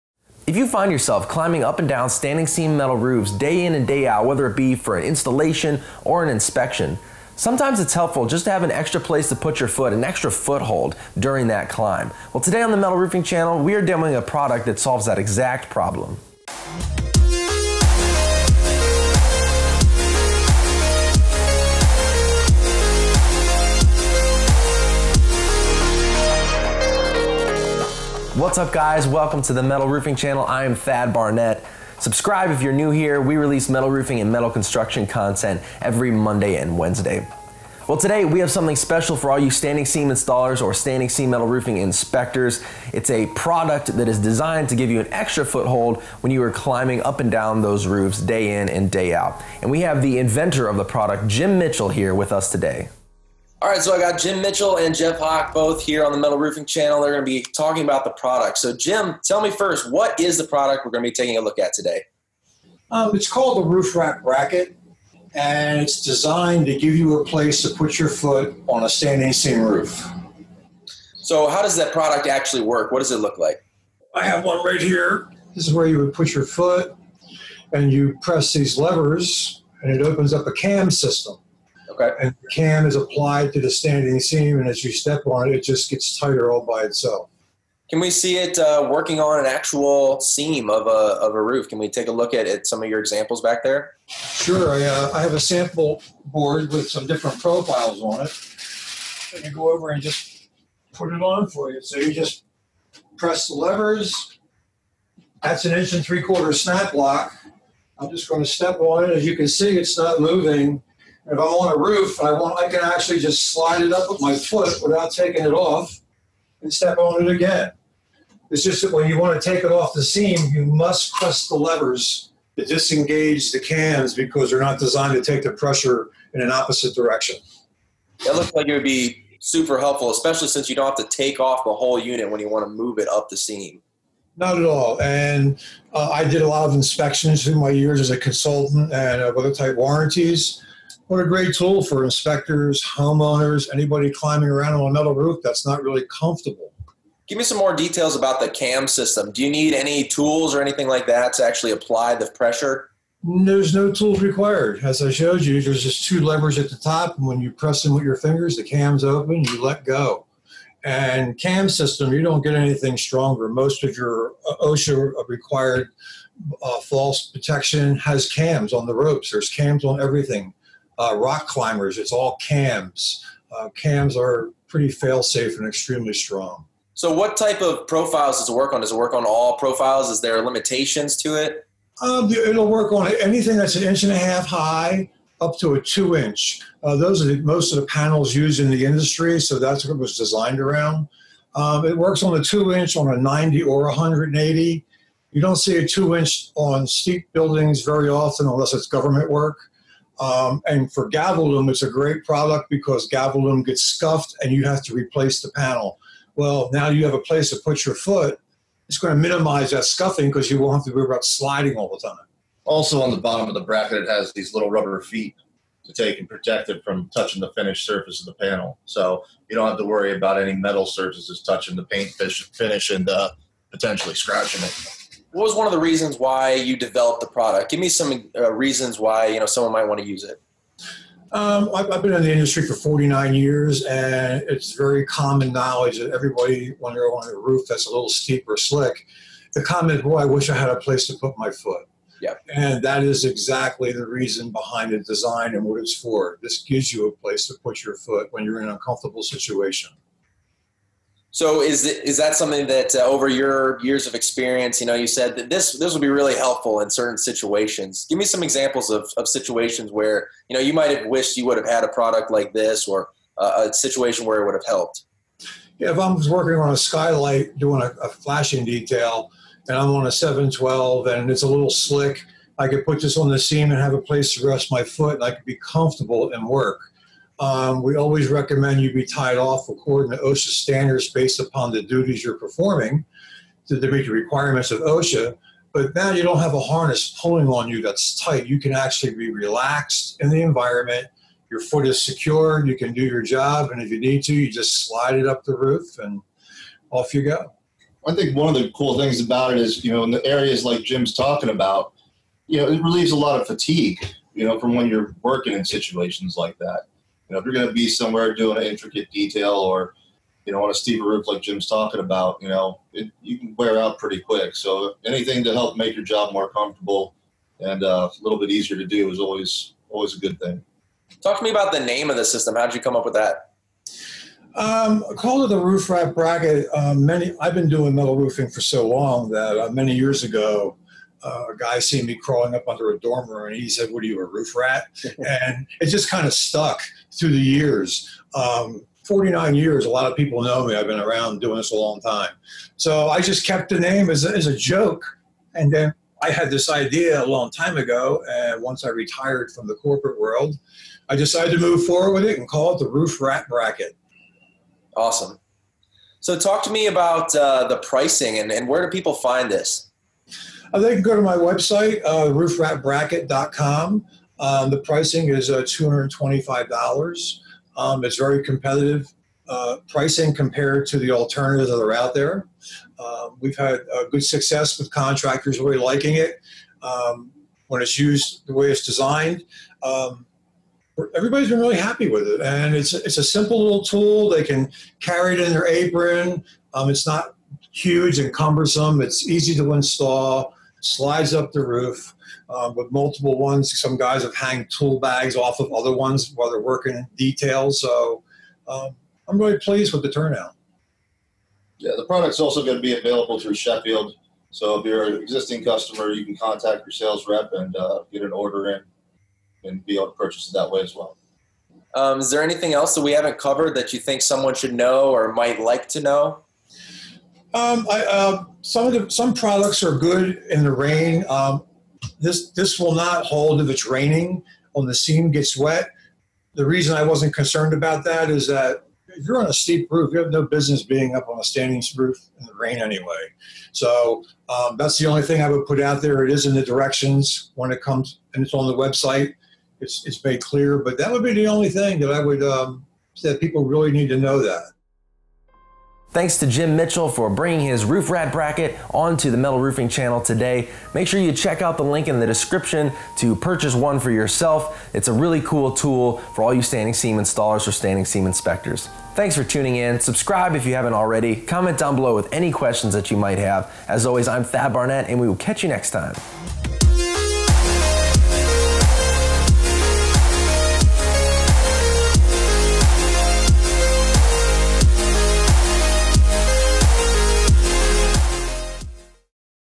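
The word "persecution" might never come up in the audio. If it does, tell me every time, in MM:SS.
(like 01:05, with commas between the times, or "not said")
not said.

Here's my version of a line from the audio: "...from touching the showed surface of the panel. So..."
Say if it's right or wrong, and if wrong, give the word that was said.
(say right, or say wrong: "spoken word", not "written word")
wrong: "finished", not "showed".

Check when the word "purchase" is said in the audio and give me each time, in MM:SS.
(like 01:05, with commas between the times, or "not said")
06:50, 07:33.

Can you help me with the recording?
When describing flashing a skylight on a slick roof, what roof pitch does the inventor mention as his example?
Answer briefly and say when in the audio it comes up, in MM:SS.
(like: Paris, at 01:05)
7/12, at 04:30.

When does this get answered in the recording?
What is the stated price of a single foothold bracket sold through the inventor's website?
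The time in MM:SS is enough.
06:05.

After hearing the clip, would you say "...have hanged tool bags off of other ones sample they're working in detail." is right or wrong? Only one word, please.
wrong.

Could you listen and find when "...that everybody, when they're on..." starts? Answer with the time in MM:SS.
03:55.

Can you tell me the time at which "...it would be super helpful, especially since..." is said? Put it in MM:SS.
02:08.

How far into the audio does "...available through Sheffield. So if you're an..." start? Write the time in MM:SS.
06:42.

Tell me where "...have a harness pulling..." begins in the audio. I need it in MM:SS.
04:46.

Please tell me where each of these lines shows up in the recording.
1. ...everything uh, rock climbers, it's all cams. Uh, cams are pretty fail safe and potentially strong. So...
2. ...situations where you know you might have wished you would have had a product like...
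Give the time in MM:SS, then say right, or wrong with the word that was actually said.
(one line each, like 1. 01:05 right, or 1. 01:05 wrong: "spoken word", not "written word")
1. 02:49 wrong: "extremely", not "potentially"
2. 04:19 right.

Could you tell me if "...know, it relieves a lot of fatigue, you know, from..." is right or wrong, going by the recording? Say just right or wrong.
right.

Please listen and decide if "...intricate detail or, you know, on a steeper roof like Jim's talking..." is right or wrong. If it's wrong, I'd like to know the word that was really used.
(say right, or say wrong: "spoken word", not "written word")
right.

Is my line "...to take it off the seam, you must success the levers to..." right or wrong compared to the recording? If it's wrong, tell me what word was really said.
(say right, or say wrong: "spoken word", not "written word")
wrong: "press", not "success".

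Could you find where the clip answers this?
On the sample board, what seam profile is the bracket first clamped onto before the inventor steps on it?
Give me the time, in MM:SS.
01:45.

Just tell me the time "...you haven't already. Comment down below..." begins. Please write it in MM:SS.
07:40.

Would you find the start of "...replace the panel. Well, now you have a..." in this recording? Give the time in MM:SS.
03:24.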